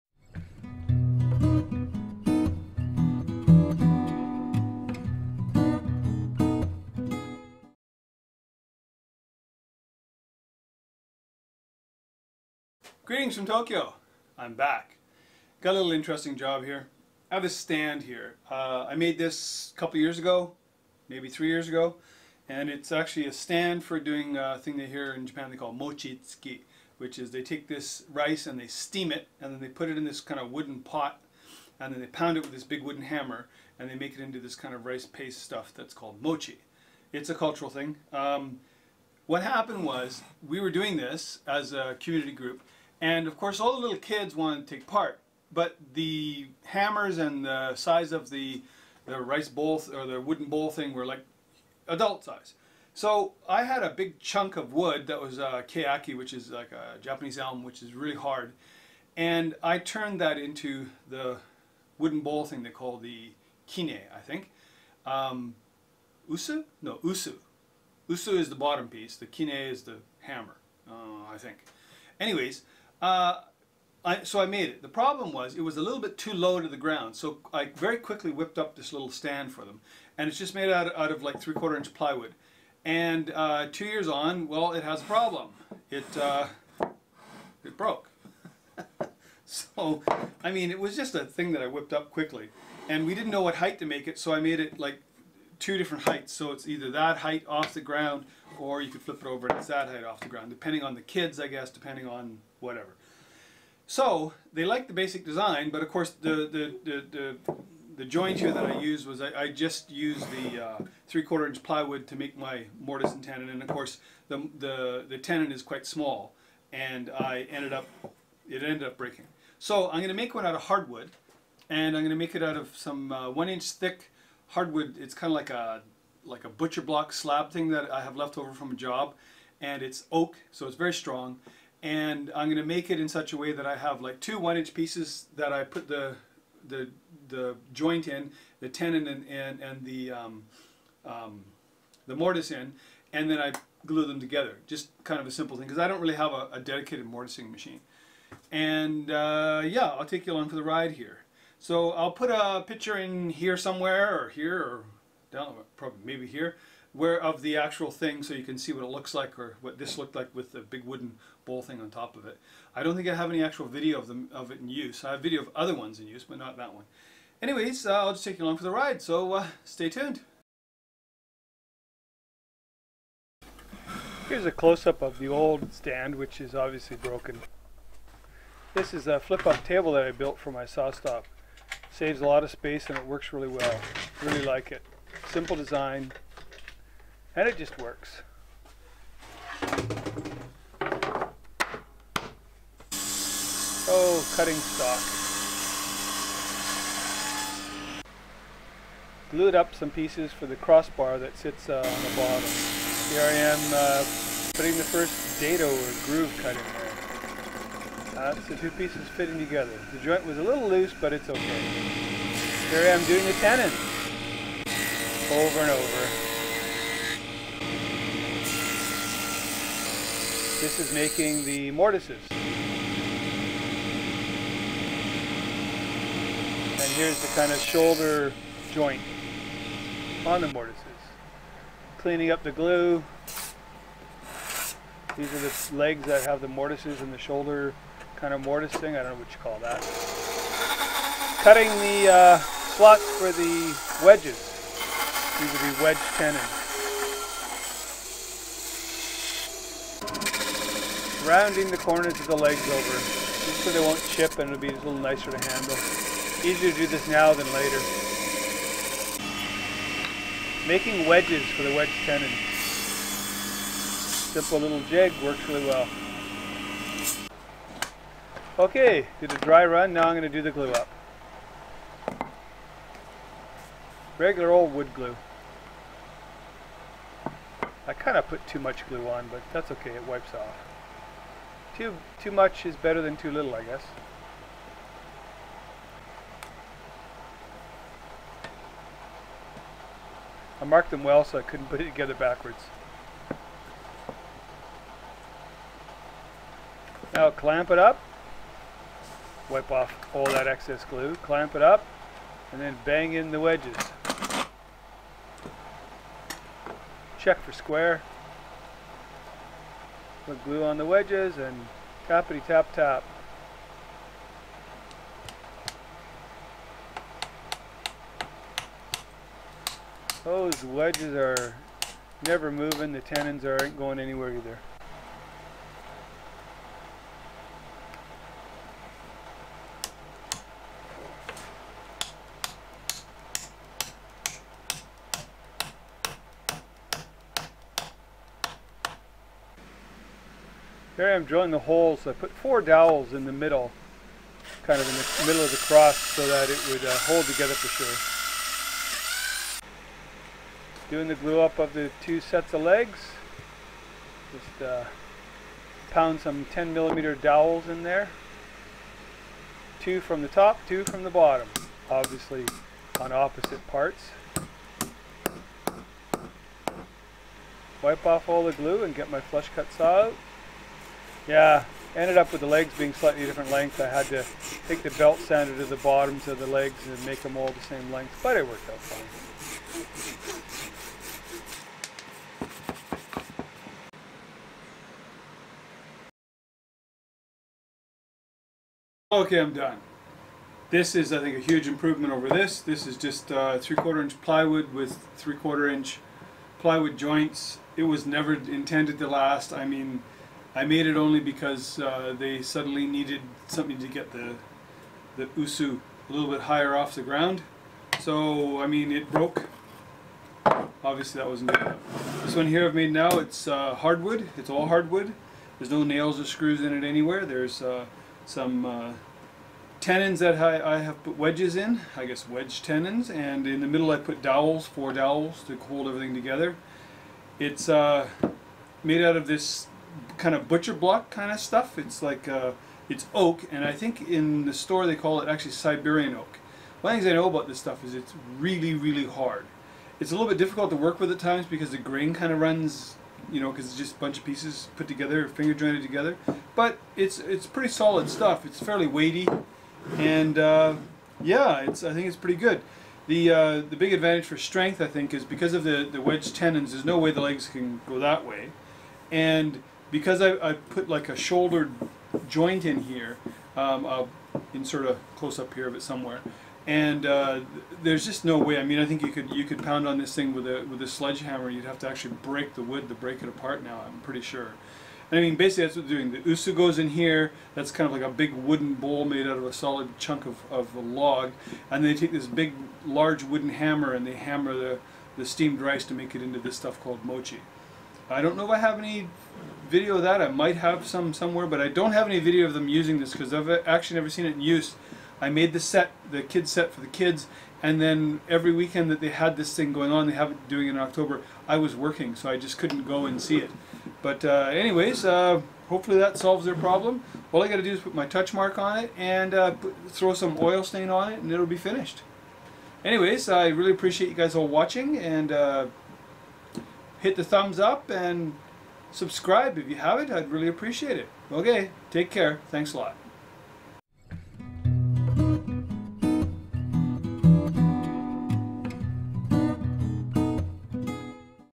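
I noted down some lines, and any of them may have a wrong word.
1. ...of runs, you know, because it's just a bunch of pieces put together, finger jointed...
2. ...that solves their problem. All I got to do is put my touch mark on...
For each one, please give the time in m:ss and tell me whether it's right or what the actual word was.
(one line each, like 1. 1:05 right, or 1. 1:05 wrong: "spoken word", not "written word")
1. 7:22 right
2. 8:25 right.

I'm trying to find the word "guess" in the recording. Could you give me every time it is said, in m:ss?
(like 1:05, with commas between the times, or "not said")
1:41, 4:43, 7:02.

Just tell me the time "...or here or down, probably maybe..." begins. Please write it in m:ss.
2:34.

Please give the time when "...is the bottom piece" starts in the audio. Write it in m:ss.
1:08.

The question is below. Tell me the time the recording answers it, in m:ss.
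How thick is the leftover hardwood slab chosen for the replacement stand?
2:03.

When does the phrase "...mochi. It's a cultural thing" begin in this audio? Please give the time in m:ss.
0:36.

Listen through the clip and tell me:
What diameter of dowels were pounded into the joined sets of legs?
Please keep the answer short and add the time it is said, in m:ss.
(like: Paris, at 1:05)
10 millimeters, at 5:56.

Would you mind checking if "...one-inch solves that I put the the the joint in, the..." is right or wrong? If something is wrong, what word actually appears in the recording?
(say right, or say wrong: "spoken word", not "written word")
wrong: "pieces", not "solves".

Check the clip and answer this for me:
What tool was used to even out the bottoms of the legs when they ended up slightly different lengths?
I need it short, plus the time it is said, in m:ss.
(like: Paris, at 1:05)
Belt sander, at 6:14.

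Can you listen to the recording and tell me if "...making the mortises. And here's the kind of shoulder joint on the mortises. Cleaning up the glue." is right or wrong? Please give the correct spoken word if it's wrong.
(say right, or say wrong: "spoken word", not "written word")
right.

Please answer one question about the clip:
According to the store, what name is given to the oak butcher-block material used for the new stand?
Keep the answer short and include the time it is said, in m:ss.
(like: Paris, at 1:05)
Siberian oak, at 7:15.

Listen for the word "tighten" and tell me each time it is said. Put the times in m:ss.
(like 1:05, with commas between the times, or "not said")
not said.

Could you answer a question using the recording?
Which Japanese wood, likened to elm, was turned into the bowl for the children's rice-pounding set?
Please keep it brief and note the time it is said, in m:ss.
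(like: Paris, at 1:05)
Keaki, at 0:55.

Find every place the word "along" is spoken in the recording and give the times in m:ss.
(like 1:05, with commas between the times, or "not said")
2:30, 2:48.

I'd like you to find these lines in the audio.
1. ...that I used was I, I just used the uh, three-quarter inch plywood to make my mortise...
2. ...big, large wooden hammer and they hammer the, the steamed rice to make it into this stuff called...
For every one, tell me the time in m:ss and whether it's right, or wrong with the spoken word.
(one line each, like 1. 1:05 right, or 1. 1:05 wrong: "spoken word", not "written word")
1. 1:48 right
2. 8:02 right.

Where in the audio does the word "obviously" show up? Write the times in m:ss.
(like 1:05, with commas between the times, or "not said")
2:56, 6:01, 6:50.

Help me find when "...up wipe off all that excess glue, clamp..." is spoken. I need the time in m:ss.
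4:57.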